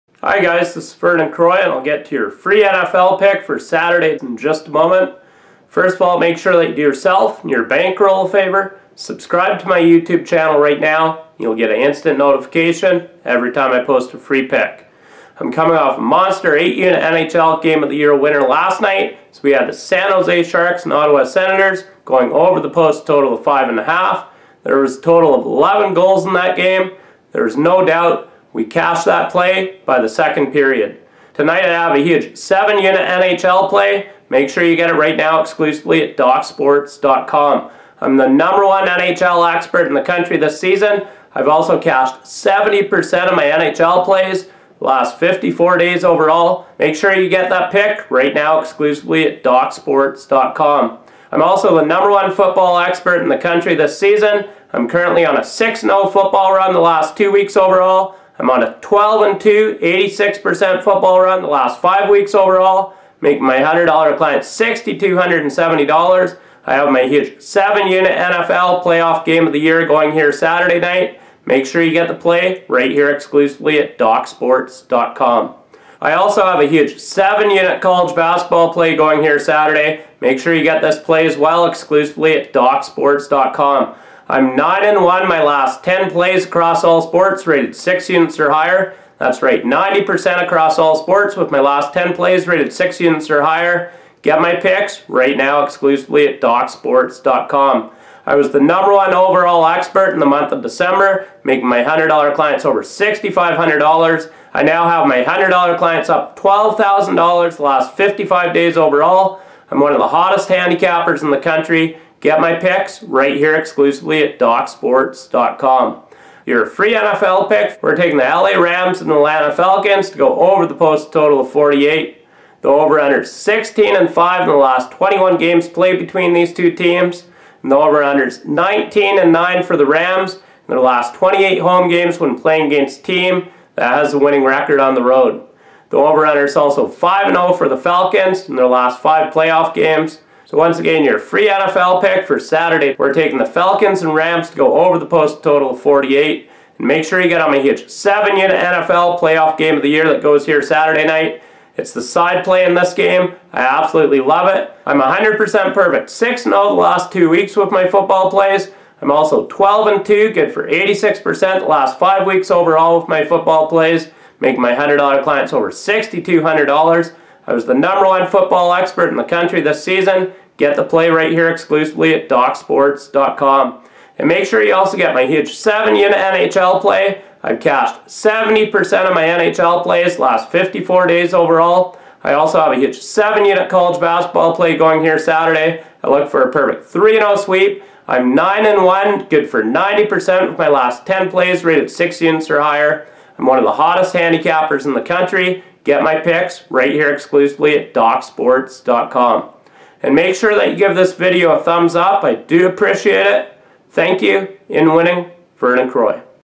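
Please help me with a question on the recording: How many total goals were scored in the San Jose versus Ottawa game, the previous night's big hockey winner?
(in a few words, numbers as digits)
11.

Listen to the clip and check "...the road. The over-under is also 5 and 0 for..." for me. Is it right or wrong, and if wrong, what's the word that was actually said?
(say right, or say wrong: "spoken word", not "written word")
right.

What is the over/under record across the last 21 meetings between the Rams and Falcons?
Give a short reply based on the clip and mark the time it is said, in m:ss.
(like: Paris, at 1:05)
16 and 5, at 2:03.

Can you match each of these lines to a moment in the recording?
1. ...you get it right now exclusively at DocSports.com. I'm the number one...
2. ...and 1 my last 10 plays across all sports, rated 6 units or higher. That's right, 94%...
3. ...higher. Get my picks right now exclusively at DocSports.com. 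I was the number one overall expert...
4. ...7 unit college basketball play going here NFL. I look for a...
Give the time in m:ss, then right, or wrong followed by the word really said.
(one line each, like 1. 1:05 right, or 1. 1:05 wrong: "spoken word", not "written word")
1. 0:34 right
2. 1:24 wrong: "90", not "94"
3. 1:33 right
4. 3:02 wrong: "Saturday", not "NFL".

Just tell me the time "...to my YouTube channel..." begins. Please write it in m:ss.
0:09.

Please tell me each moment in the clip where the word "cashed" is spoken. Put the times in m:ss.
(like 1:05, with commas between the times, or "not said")
0:28, 0:41, 2:57.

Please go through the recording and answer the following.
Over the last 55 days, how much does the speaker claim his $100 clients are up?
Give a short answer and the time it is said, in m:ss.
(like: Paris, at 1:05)
$12,000, at 1:46.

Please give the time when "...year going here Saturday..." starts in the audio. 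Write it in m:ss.
1:09.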